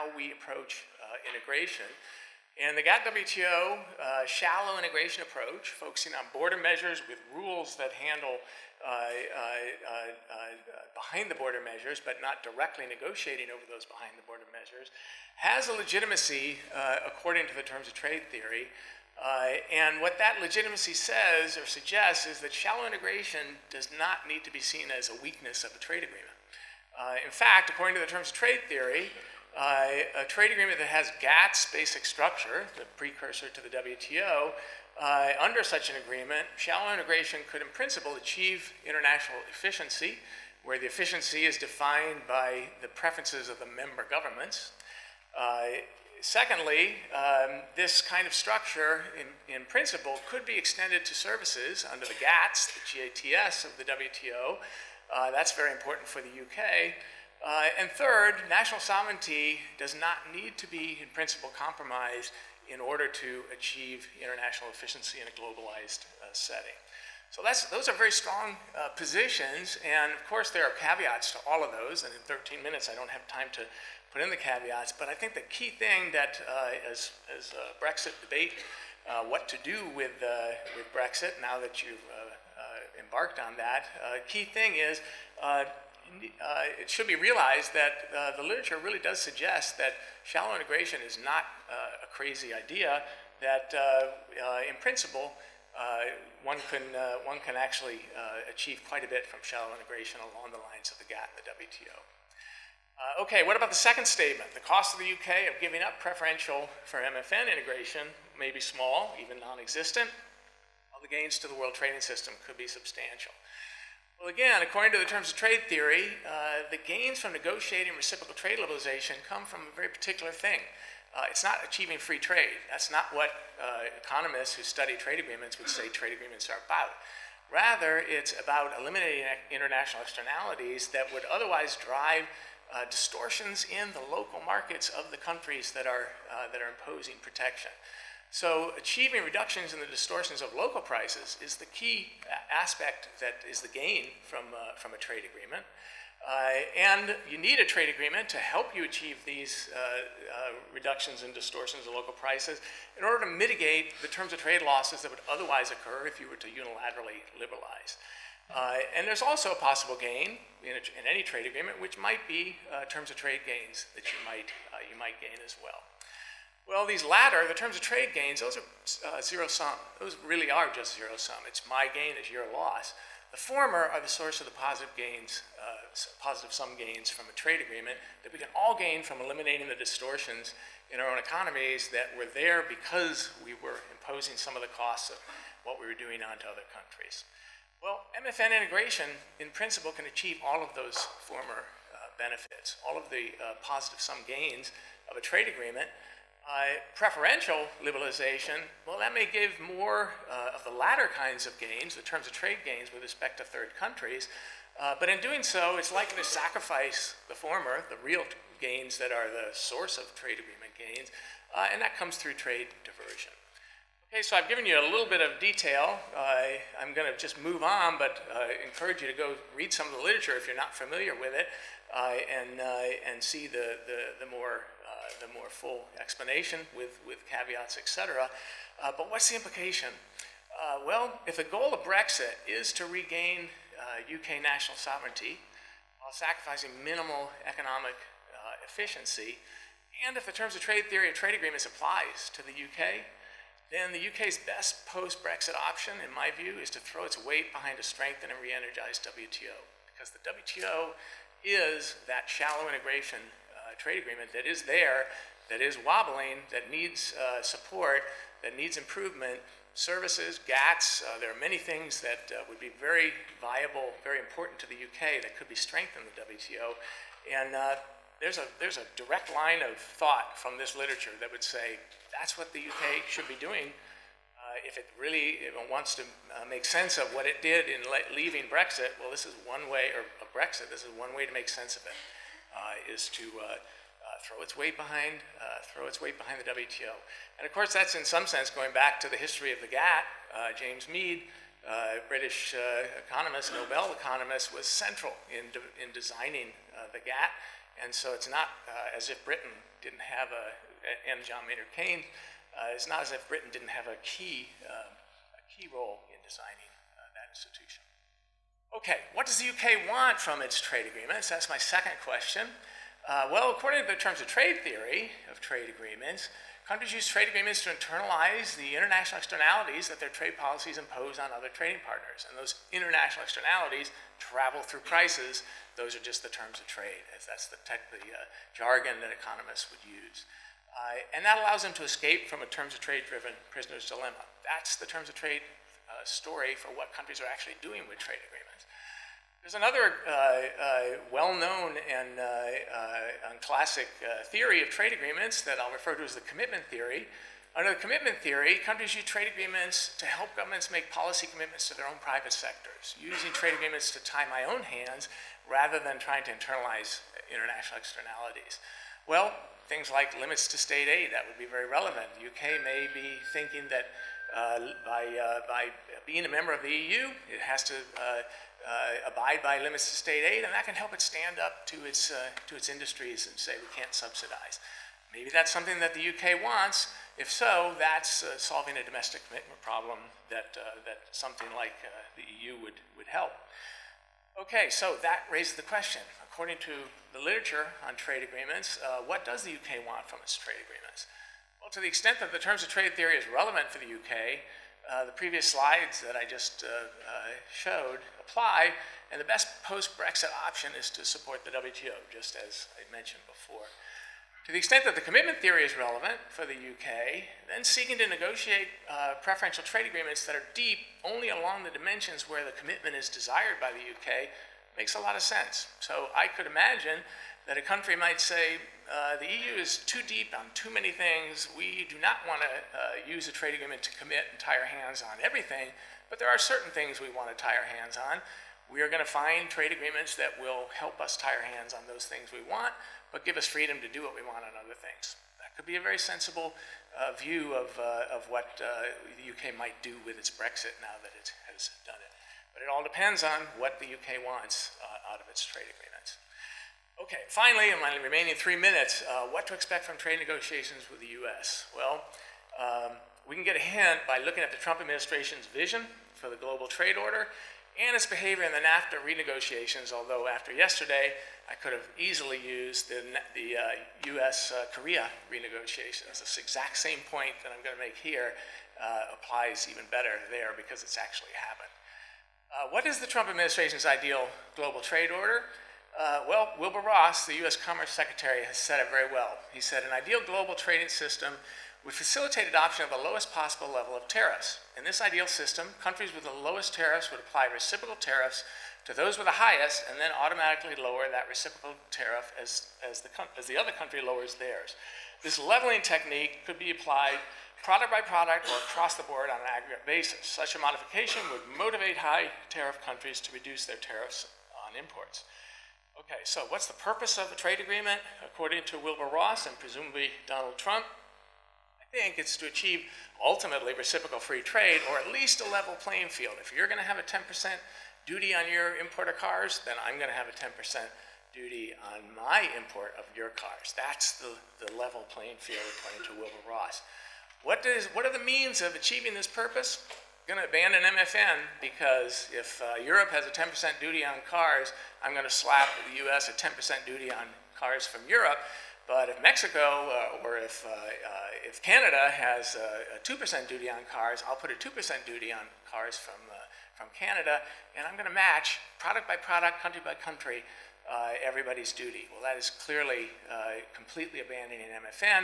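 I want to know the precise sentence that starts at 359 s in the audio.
Well, things like limits to state aid, that would be very relevant.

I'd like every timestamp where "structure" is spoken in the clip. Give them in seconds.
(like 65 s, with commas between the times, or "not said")
32 s, 48 s.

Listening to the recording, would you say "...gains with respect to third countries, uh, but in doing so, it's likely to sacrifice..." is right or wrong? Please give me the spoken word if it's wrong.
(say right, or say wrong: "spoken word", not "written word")
right.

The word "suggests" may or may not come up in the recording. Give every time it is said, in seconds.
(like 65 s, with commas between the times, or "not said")
21 s, 89 s.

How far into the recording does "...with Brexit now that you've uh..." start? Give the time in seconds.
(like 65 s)
80 s.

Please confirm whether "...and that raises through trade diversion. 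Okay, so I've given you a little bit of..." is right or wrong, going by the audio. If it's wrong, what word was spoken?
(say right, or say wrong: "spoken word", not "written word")
wrong: "comes", not "raises".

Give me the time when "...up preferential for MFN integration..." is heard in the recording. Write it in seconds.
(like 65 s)
105 s.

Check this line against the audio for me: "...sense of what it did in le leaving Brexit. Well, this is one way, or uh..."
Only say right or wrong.
right.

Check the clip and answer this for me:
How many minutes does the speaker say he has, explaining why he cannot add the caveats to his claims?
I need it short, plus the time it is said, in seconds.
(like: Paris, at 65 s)
13, at 72 s.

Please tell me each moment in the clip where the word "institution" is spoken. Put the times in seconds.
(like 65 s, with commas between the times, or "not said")
307 s.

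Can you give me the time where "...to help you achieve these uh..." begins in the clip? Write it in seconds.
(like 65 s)
148 s.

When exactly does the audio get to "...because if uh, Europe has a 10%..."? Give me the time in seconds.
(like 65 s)
531 s.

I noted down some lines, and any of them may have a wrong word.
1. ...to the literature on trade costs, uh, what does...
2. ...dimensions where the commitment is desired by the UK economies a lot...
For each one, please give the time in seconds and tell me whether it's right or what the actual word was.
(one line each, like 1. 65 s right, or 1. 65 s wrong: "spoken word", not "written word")
1. 386 s wrong: "agreements", not "costs"
2. 411 s wrong: "makes", not "economies".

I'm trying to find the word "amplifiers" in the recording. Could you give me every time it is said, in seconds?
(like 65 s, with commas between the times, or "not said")
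not said.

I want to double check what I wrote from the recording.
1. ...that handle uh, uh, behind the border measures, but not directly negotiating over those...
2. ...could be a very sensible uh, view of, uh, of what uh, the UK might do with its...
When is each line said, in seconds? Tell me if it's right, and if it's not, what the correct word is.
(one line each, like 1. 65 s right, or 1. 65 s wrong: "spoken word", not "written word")
1. 7 s right
2. 435 s right.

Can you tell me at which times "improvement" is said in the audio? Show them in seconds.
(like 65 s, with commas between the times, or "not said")
258 s.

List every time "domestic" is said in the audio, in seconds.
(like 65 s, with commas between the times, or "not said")
378 s.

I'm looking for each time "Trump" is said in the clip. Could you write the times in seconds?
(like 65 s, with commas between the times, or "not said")
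454 s, 473 s, 510 s.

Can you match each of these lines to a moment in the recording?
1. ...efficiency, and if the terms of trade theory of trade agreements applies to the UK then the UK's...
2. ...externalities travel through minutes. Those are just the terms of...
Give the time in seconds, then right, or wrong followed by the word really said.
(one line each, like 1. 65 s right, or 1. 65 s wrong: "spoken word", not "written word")
1. 238 s right
2. 323 s wrong: "prices", not "minutes".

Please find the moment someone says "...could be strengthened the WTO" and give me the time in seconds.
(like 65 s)
265 s.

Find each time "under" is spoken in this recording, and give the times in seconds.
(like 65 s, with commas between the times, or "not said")
35 s, 51 s, 347 s.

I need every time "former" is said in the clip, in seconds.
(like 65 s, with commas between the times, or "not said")
173 s, 191 s, 207 s.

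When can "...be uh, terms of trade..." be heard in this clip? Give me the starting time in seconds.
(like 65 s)
162 s.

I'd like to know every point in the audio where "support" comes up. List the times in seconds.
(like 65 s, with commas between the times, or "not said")
257 s, 401 s.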